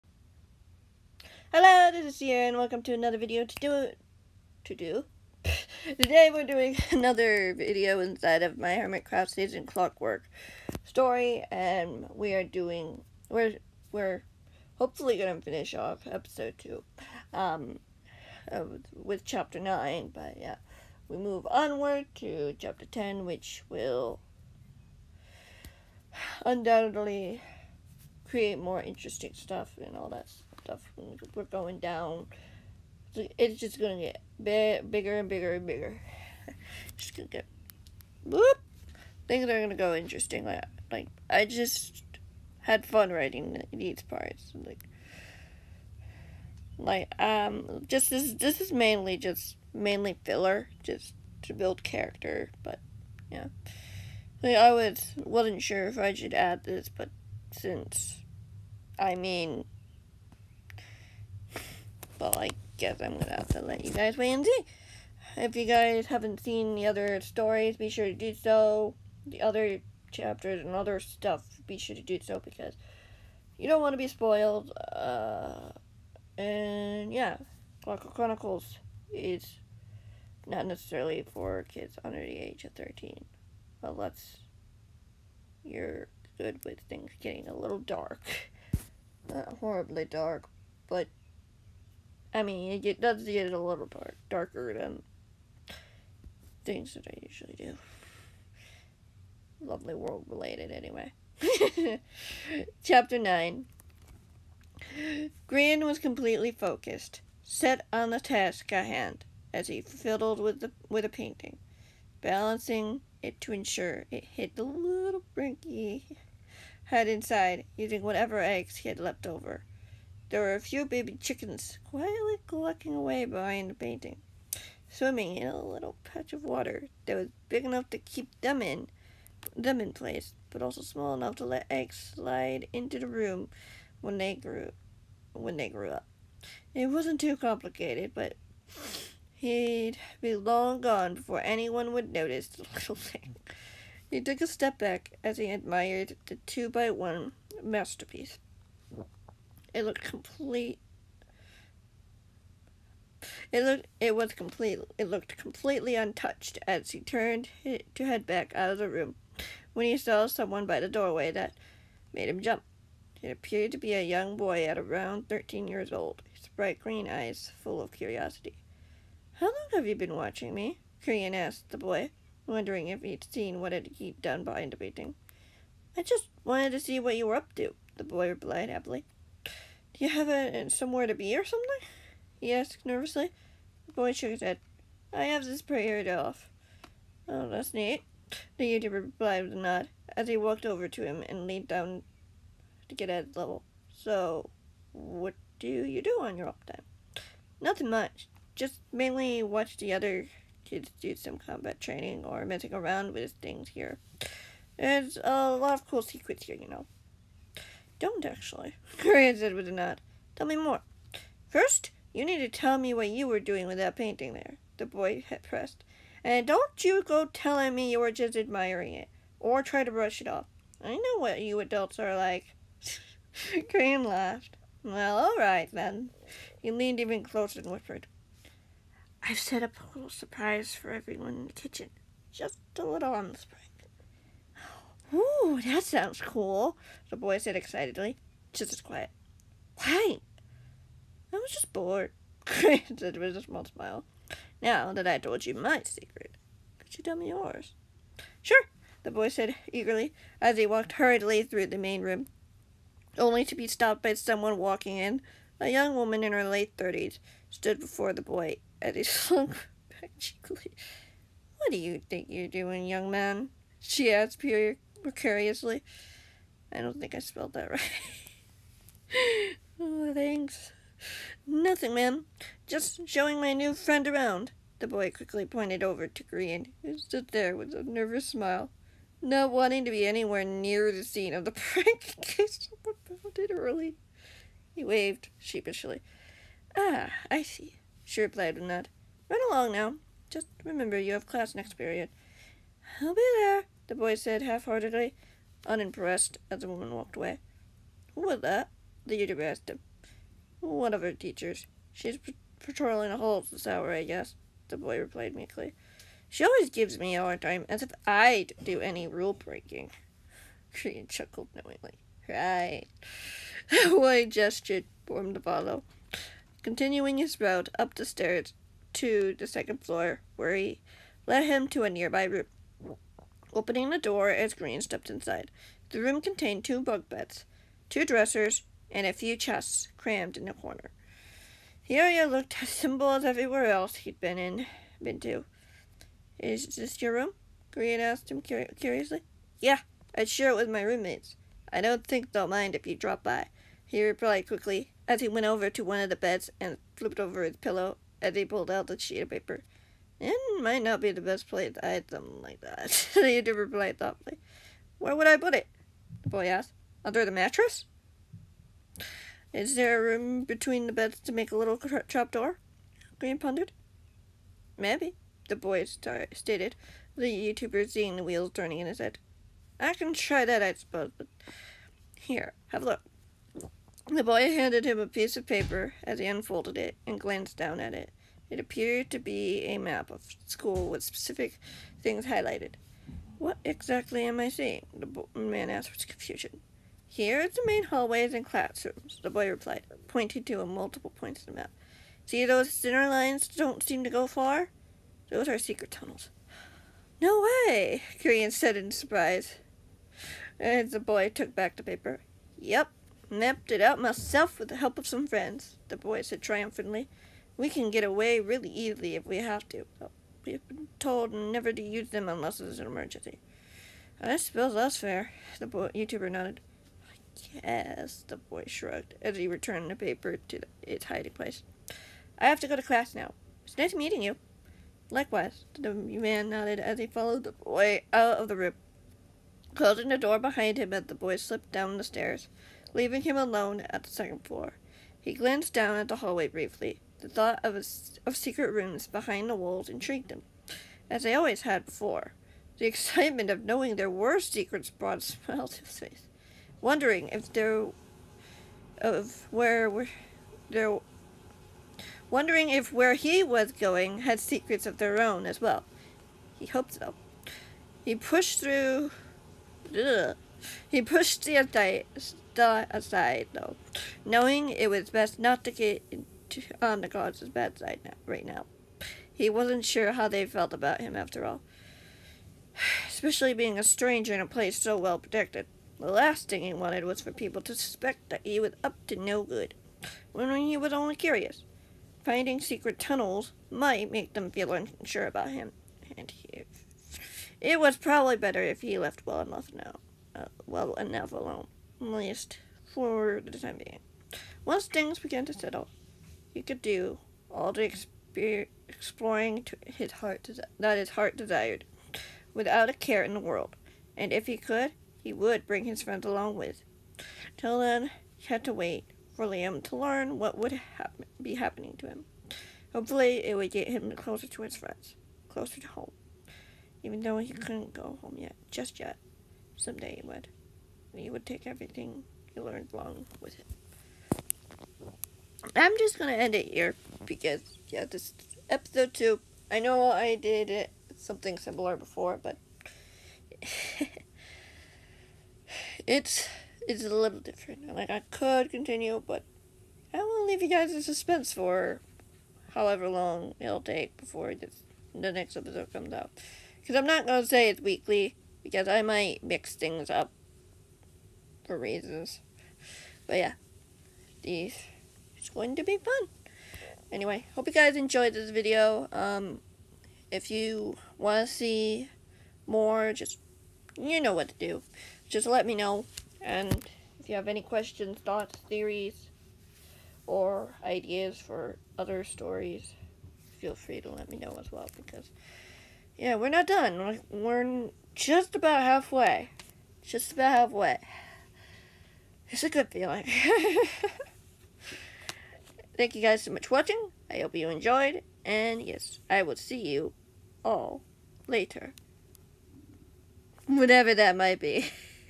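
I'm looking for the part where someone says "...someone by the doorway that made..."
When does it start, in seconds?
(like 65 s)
160 s.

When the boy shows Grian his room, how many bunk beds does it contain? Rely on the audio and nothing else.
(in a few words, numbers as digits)
2.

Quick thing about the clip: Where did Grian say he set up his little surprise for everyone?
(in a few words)
the kitchen.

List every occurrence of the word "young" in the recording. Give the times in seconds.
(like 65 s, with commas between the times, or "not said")
164 s, 255 s, 262 s.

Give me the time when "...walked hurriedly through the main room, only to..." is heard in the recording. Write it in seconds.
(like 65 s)
250 s.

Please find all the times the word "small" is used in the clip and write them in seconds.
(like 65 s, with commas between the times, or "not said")
130 s, 243 s.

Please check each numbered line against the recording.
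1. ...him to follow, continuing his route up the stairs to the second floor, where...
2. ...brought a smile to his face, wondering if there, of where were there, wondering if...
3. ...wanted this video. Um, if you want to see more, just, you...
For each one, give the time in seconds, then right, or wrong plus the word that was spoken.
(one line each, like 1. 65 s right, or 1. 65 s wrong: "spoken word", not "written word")
1. 315 s right
2. 444 s right
3. 557 s wrong: "enjoyed", not "wanted".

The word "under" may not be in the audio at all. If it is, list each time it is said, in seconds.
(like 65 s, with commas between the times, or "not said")
82 s, 357 s.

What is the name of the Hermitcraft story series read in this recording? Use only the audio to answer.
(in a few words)
Clockwork Chronicles.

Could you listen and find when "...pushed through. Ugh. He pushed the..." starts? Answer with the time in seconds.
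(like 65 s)
458 s.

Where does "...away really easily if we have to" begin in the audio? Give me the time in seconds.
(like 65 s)
408 s.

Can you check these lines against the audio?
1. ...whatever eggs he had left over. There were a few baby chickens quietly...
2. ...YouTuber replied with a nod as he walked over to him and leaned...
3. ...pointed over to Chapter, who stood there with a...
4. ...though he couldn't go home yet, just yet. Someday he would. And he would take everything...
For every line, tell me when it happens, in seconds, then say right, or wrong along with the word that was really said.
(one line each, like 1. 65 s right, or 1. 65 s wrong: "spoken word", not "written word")
1. 118 s right
2. 188 s right
3. 275 s wrong: "Grian", not "Chapter"
4. 517 s right.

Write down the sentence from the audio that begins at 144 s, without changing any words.
He took a step back as he admired the two by one masterpiece.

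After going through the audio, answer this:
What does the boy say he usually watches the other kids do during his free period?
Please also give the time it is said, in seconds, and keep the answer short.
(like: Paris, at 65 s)
combat training, at 201 s.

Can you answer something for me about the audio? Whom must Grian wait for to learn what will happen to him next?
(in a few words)
Liam.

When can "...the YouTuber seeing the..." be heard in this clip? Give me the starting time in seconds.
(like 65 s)
367 s.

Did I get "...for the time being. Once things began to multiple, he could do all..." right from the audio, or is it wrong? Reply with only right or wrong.
wrong.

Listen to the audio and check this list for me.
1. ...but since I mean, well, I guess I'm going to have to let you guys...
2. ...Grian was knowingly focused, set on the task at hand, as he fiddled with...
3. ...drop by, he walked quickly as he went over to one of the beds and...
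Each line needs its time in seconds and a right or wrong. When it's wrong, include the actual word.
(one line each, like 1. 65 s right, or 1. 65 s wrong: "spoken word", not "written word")
1. 56 s right
2. 105 s wrong: "completely", not "knowingly"
3. 342 s wrong: "replied", not "walked".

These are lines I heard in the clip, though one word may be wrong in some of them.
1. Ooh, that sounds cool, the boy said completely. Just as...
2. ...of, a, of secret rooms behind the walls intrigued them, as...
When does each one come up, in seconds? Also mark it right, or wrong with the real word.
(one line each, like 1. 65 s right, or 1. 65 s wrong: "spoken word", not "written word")
1. 235 s wrong: "excitedly", not "completely"
2. 437 s right.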